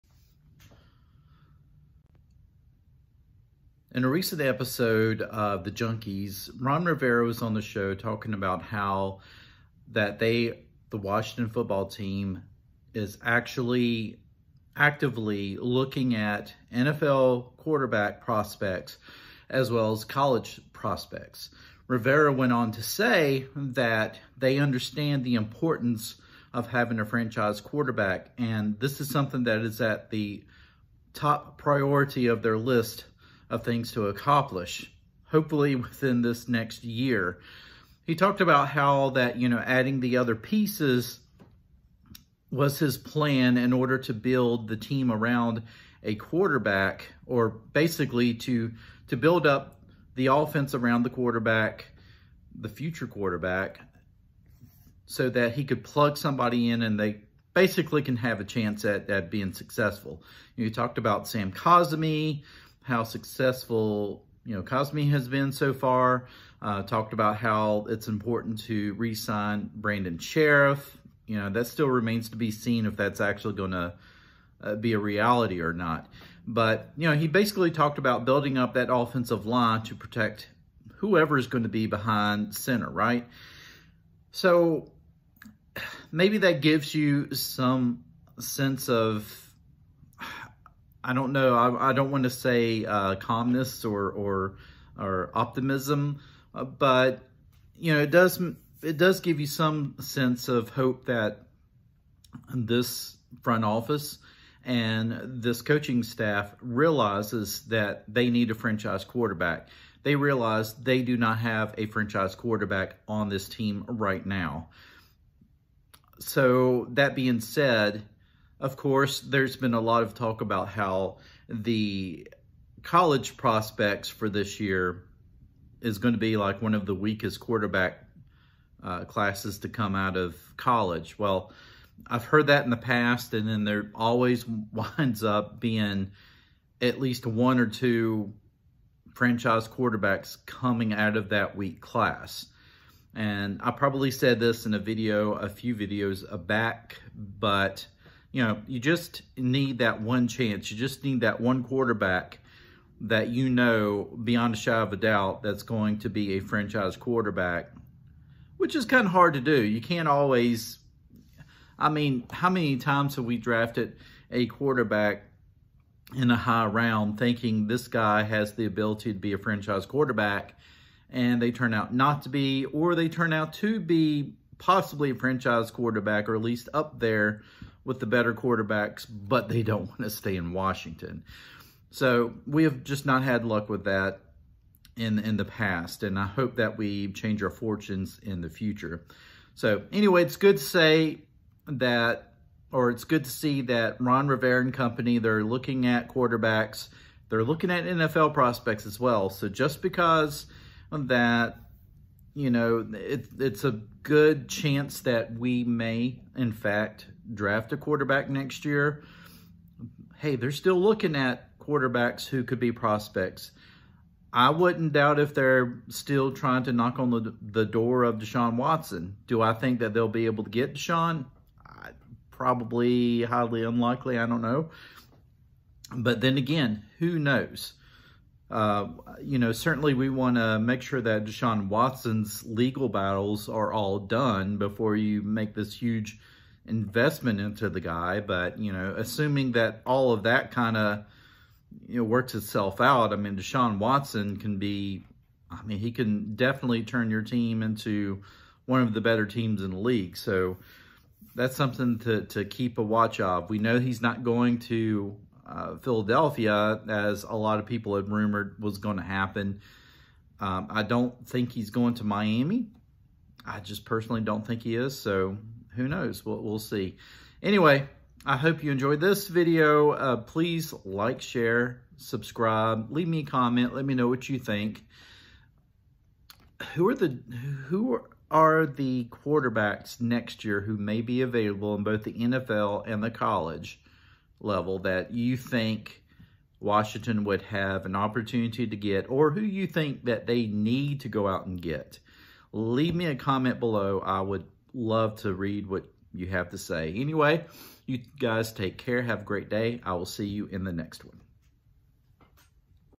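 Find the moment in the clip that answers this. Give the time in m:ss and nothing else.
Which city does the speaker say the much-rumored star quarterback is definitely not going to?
4:15.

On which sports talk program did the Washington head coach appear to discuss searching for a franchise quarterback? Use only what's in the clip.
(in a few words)
The Junkies.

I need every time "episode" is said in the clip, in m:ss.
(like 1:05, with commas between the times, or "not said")
0:04.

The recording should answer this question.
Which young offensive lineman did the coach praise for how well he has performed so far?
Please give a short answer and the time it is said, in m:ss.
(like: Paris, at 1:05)
Sam Cosmi, at 1:01.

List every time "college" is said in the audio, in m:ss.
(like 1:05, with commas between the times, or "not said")
0:20, 2:02, 2:10, 4:43.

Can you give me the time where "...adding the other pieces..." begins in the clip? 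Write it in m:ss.
0:39.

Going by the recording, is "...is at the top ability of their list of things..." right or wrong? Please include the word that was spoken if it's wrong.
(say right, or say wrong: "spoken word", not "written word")
wrong: "priority", not "ability".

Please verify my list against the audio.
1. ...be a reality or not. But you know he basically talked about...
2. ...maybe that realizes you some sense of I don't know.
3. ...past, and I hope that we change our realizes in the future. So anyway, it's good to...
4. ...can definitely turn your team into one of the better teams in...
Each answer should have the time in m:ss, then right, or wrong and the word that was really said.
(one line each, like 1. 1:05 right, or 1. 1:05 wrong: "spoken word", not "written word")
1. 1:14 right
2. 1:26 wrong: "gives", not "realizes"
3. 3:05 wrong: "fortunes", not "realizes"
4. 4:05 right.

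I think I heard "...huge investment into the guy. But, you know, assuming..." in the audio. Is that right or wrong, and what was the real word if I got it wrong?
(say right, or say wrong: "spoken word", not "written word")
right.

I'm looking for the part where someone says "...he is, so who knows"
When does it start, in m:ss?
4:24.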